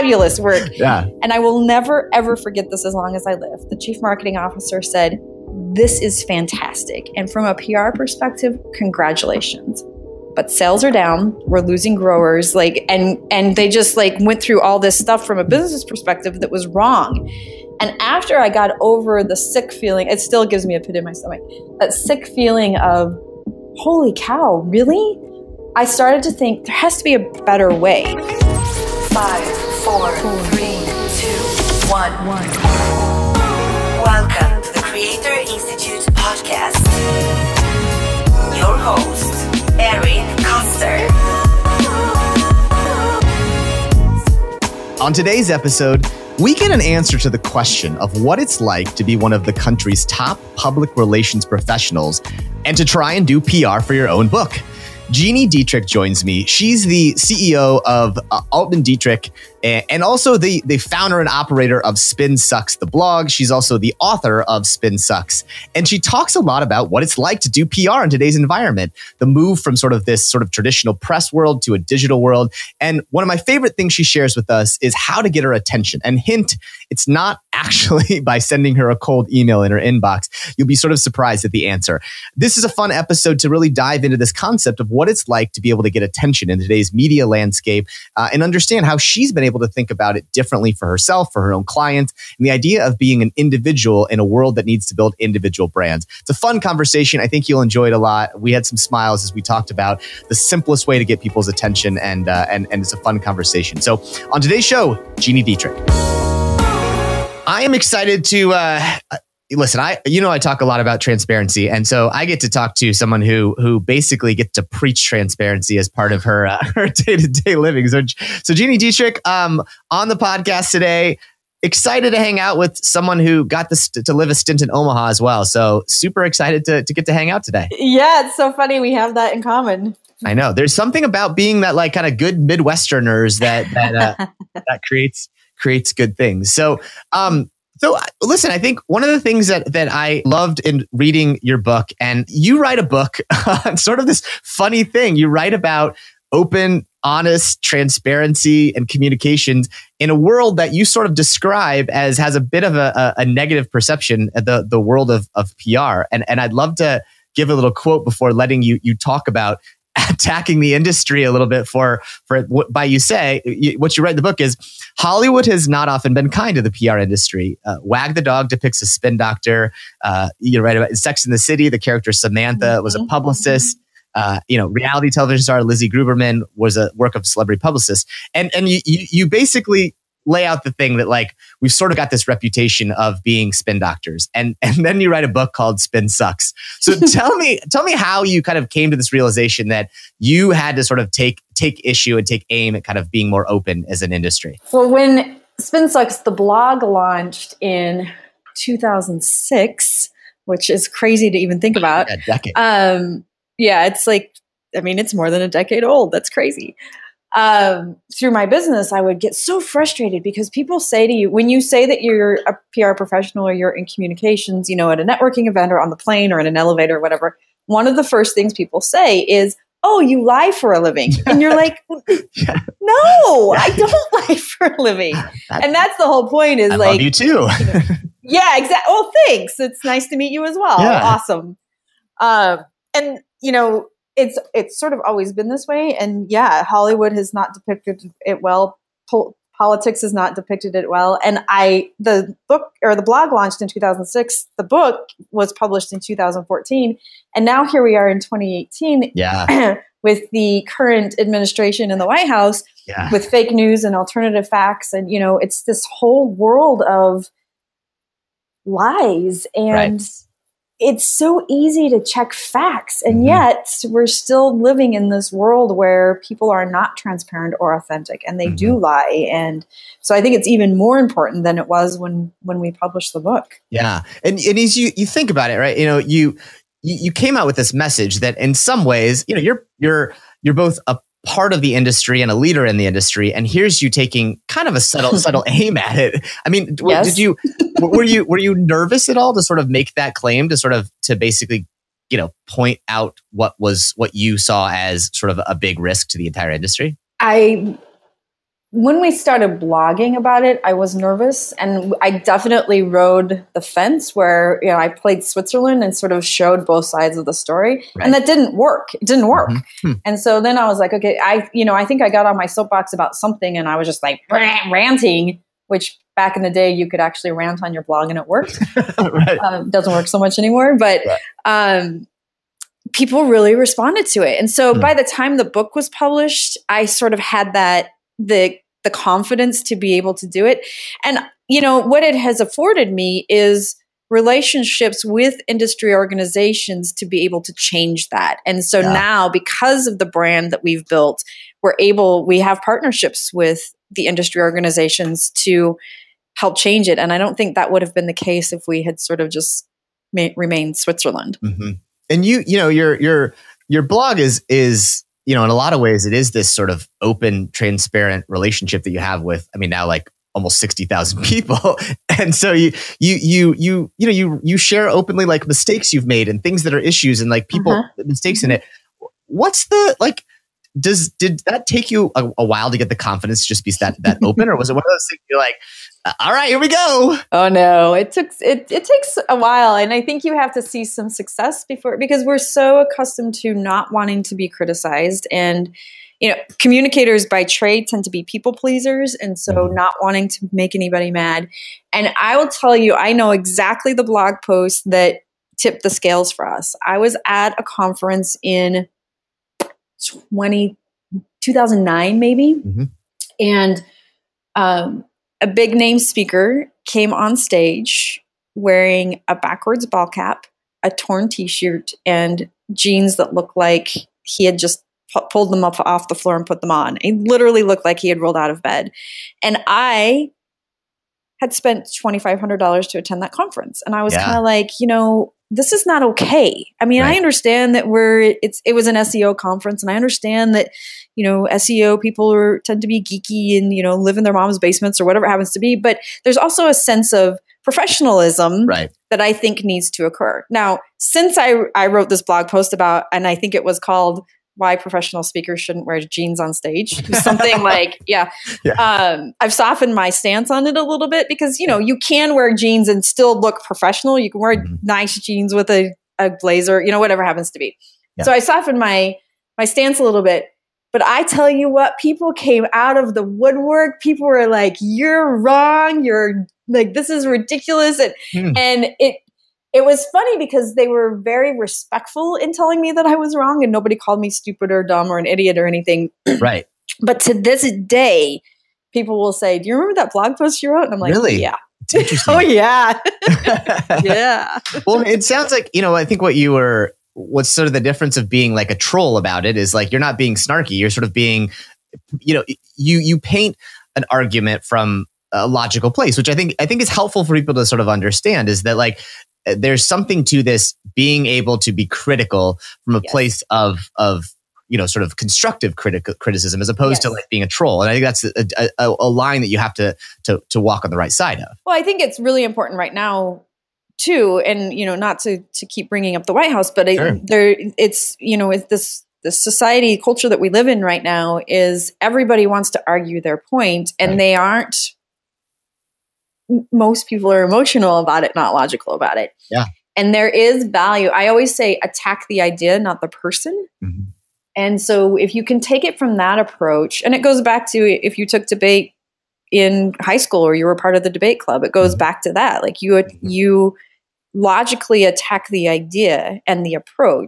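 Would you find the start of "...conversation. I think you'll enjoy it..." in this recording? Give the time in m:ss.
1:36.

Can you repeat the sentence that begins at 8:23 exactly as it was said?
place of of you know sort of constructive criti- criticism as opposed yes.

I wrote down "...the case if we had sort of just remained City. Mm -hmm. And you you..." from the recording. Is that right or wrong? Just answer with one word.
wrong.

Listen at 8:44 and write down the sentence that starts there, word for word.
they aren't most people are emotional about it, not logical about it.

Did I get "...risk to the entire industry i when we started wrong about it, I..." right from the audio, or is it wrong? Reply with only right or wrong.
wrong.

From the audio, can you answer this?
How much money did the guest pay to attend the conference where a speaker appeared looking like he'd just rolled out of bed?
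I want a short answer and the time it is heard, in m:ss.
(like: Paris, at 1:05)
$2,500, at 7:01.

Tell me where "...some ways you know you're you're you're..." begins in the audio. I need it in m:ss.
4:38.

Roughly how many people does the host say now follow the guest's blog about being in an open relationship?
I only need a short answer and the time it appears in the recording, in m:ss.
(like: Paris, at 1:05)
60,000, at 6:00.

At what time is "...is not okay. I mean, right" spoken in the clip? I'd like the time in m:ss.
7:05.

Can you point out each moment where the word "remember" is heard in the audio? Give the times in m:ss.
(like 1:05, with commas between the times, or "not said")
7:59.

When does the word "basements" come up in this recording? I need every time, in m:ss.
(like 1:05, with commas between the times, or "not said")
7:14.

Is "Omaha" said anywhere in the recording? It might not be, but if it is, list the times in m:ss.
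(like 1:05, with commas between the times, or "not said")
2:04.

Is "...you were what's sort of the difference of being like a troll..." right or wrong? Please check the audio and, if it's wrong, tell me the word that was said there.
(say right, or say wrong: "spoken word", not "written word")
right.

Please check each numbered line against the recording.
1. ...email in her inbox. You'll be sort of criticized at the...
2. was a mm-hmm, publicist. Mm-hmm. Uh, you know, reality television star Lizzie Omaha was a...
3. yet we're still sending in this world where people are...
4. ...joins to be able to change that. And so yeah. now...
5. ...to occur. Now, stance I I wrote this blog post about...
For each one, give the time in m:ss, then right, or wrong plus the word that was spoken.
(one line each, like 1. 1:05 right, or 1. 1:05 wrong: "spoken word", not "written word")
1. 1:19 wrong: "surprised", not "criticized"
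2. 2:52 wrong: "Grubman", not "Omaha"
3. 4:23 wrong: "living", not "sending"
4. 5:35 wrong: "organizations", not "joins"
5. 7:19 wrong: "since", not "stance".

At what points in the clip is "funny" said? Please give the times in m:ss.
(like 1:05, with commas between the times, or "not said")
2:08, 2:24, 7:50.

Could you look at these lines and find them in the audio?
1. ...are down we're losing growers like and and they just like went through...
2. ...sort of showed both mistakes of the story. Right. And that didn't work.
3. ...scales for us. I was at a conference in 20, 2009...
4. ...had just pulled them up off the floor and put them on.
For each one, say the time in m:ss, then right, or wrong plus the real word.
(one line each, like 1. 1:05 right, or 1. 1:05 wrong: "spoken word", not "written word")
1. 0:10 right
2. 5:05 wrong: "sides", not "mistakes"
3. 6:35 right
4. 6:54 right.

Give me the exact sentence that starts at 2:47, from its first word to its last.
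Uh, Wag the Dog depicts a spin doctor.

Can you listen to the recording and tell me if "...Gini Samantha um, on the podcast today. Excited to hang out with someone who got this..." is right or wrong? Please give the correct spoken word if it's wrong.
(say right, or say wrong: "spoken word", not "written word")
wrong: "Dietrich", not "Samantha".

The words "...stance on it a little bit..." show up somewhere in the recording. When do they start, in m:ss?
7:30.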